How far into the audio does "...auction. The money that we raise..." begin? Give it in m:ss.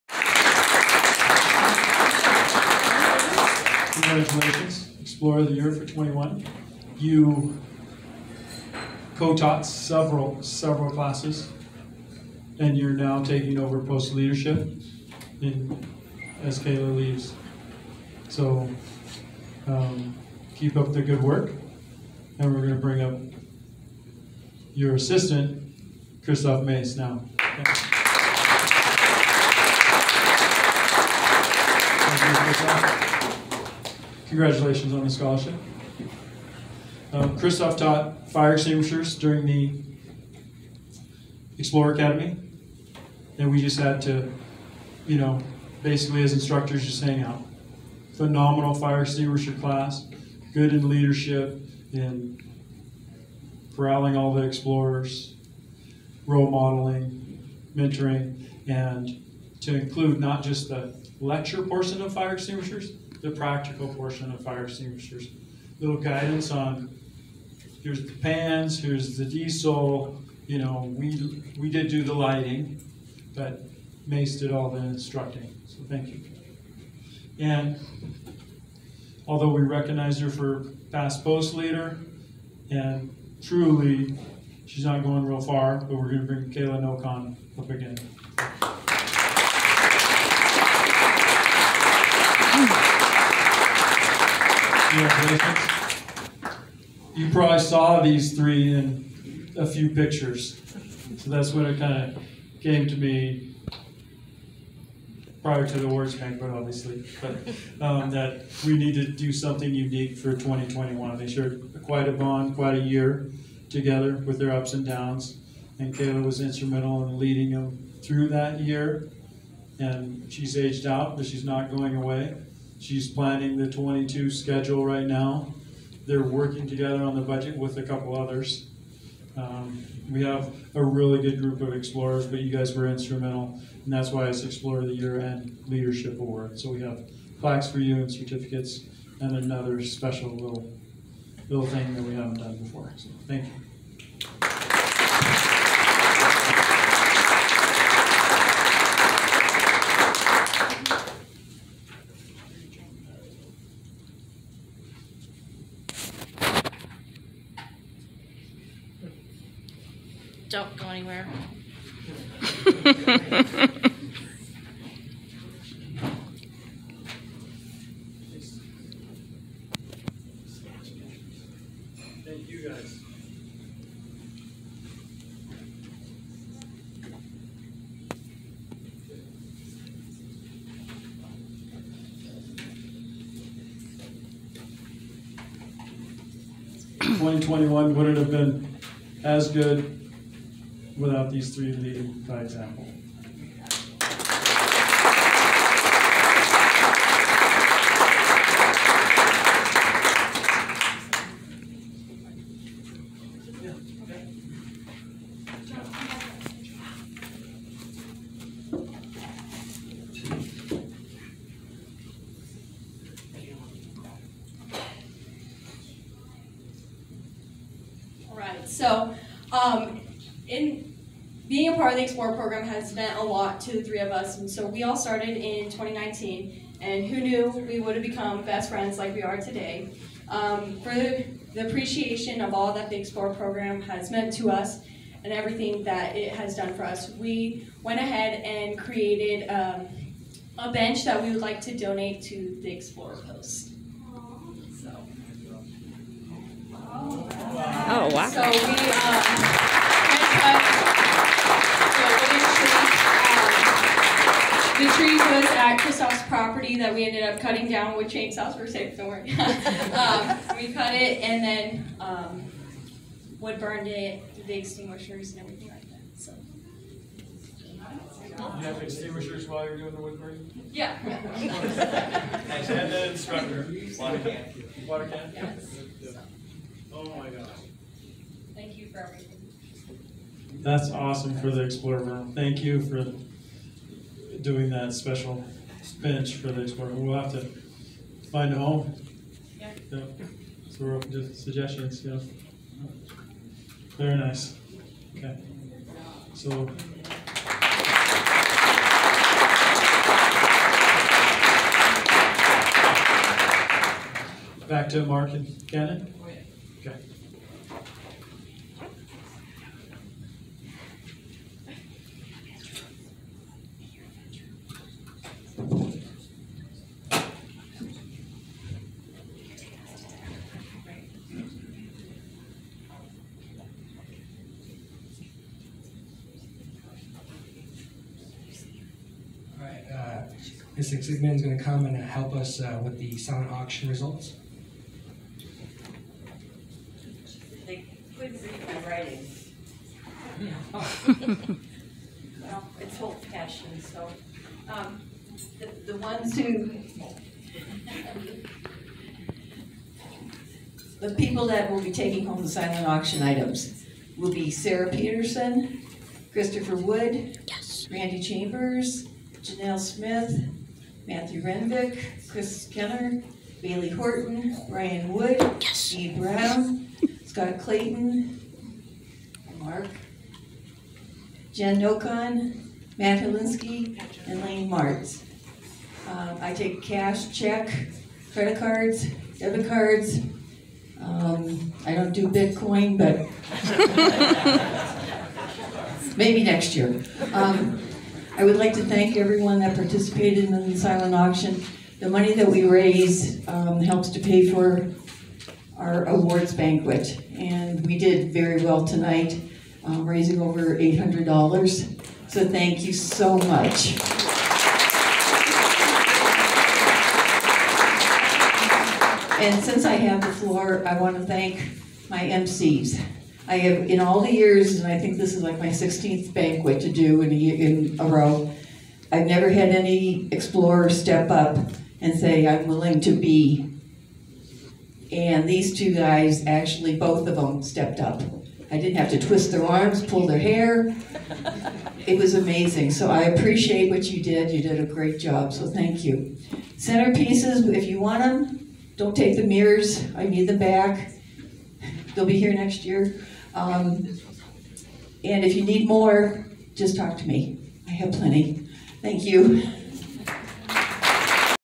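6:31.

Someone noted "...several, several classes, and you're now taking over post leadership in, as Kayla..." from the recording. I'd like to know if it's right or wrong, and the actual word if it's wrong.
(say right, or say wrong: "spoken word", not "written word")
right.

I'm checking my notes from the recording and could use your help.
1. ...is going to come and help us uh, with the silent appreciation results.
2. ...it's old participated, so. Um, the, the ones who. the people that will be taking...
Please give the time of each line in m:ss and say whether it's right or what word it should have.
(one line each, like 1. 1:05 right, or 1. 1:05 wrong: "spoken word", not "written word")
1. 5:31 wrong: "auction", not "appreciation"
2. 5:42 wrong: "fashioned", not "participated".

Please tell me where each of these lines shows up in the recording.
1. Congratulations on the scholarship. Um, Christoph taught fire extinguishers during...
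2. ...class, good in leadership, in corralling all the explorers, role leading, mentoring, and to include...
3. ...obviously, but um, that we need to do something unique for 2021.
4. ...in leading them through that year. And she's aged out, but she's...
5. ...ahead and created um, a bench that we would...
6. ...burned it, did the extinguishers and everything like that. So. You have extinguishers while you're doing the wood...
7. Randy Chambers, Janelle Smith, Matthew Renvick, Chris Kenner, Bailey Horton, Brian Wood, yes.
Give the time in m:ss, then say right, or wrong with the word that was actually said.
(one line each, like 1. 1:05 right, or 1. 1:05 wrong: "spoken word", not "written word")
1. 0:34 right
2. 0:49 wrong: "modeling", not "leading"
3. 1:46 right
4. 1:57 right
5. 3:57 right
6. 4:23 right
7. 5:57 right.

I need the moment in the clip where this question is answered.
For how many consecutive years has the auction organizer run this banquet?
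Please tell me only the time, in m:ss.
6:55.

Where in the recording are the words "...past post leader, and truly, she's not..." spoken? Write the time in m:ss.
1:20.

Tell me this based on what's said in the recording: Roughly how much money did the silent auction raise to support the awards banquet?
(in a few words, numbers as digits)
Over $800.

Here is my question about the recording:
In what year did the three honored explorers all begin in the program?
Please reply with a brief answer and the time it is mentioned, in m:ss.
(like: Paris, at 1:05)
2019, at 3:45.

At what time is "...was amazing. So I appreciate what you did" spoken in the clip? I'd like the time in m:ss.
7:12.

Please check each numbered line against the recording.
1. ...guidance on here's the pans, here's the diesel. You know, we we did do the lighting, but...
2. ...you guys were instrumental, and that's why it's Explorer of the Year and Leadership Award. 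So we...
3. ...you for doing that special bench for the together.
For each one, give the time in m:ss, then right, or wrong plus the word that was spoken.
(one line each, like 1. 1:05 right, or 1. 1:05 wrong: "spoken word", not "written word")
1. 1:05 right
2. 2:12 right
3. 4:42 wrong: "explorer", not "together".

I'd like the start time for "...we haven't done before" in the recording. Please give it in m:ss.
2:22.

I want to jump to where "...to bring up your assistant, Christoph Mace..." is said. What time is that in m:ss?
0:22.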